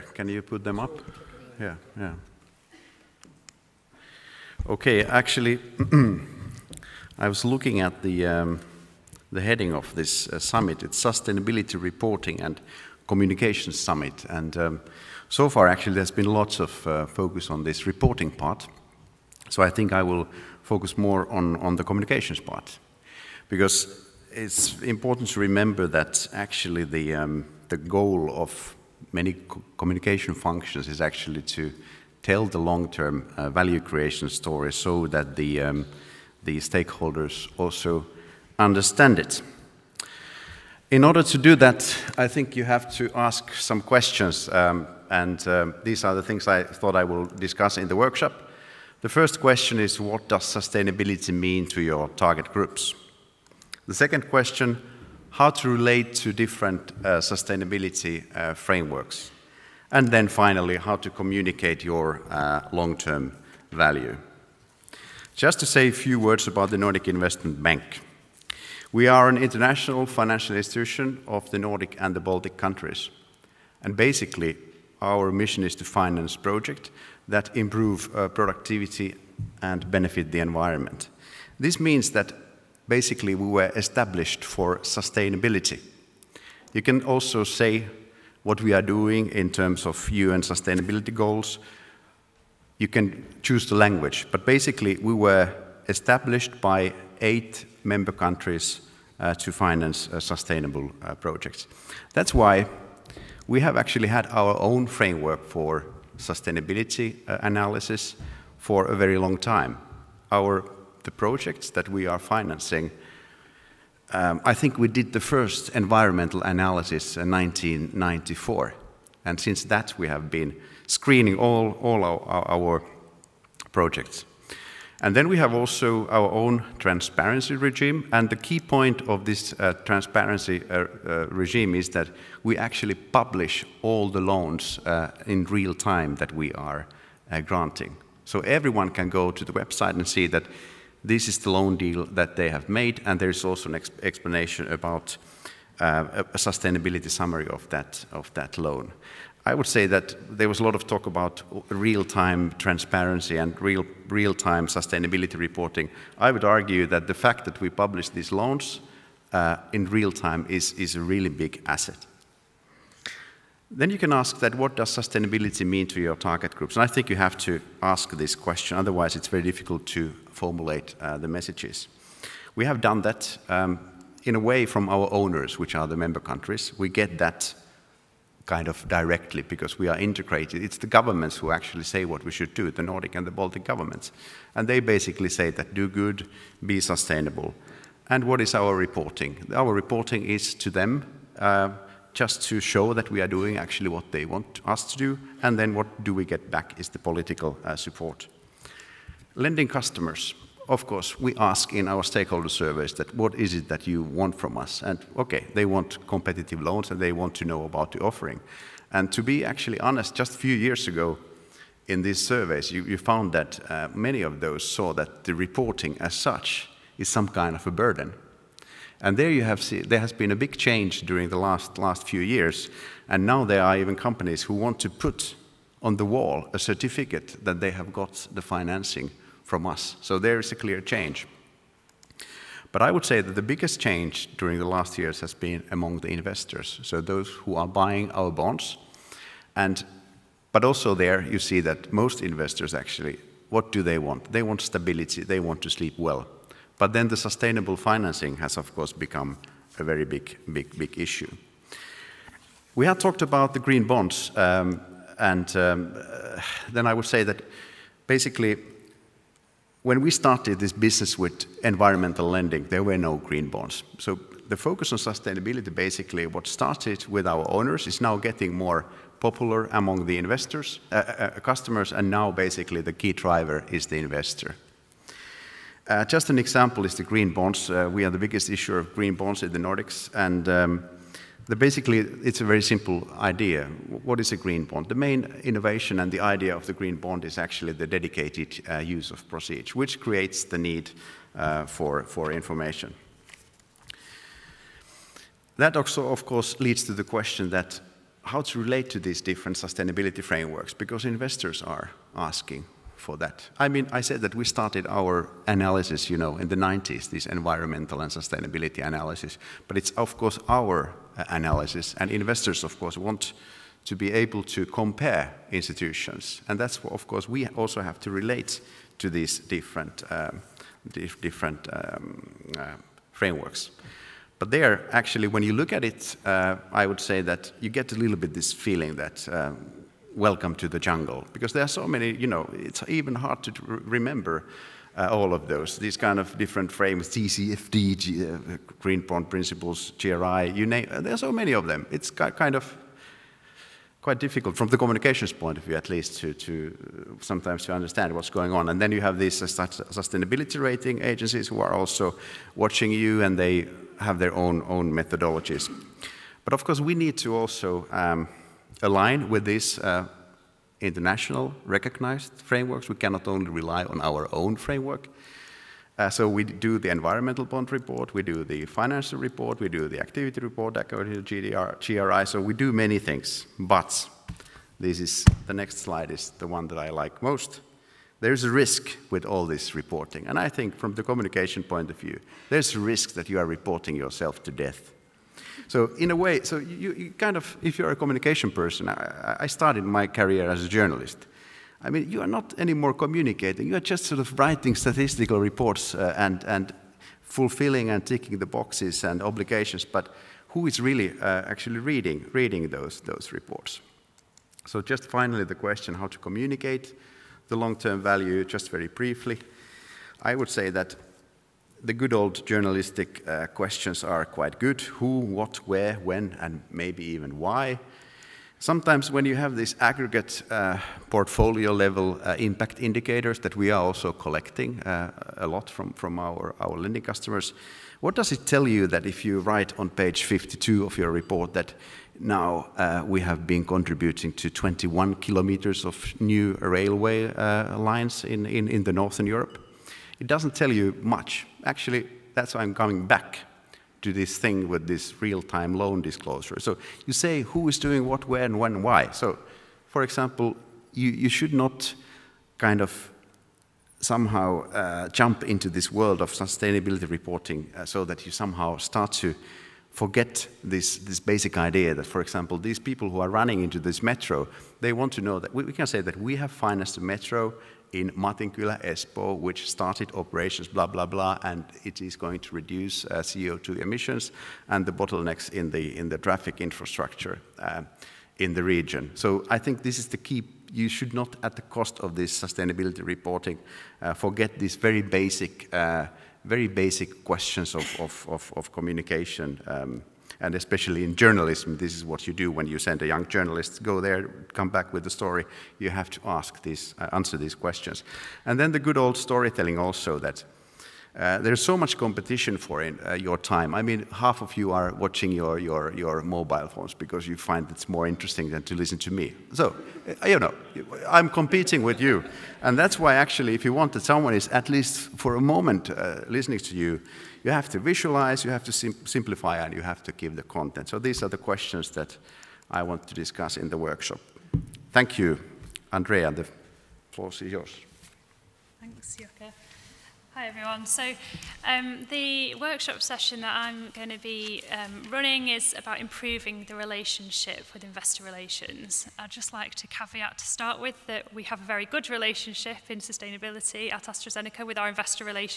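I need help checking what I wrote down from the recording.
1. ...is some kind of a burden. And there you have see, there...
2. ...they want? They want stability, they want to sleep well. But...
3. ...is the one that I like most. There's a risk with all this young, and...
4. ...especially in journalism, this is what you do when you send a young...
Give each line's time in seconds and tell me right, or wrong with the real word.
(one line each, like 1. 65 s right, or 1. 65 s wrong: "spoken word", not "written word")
1. 216 s right
2. 243 s right
3. 376 s wrong: "reporting", not "young"
4. 490 s right.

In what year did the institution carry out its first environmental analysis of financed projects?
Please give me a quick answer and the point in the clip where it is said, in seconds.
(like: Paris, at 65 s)
1994, at 117 s.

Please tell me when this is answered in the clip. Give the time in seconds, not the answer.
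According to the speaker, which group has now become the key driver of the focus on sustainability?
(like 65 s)
273 s.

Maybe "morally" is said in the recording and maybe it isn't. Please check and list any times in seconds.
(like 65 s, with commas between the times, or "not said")
not said.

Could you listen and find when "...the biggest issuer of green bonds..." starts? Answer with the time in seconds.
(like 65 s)
278 s.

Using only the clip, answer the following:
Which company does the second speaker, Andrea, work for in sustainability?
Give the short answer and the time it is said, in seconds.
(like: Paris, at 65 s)
AstraZeneca, at 544 s.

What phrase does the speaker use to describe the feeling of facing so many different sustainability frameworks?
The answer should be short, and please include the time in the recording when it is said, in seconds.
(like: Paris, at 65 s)
Welcome to the Jungle, at 330 s.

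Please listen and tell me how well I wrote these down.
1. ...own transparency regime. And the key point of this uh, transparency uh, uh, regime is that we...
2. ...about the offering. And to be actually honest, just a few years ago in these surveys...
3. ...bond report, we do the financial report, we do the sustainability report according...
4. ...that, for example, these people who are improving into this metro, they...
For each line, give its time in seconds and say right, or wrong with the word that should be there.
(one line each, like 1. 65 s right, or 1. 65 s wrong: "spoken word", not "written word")
1. 126 s right
2. 207 s right
3. 367 s wrong: "activity", not "sustainability"
4. 461 s wrong: "running", not "improving".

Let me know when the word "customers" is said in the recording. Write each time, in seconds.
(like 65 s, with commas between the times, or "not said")
199 s, 271 s, 427 s.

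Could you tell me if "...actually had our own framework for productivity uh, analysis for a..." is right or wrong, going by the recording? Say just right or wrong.
wrong.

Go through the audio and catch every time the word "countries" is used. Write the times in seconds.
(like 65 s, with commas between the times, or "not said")
72 s, 98 s, 176 s.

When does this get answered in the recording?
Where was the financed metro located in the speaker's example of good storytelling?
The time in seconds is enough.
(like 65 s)
468 s.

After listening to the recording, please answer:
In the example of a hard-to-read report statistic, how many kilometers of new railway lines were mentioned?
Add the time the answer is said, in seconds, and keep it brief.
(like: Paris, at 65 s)
21, at 434 s.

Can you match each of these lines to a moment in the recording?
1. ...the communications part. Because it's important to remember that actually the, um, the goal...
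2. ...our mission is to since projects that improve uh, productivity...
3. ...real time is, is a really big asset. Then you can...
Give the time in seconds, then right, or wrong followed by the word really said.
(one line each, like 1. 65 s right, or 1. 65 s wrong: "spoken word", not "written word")
1. 21 s right
2. 75 s wrong: "finance", not "since"
3. 159 s right.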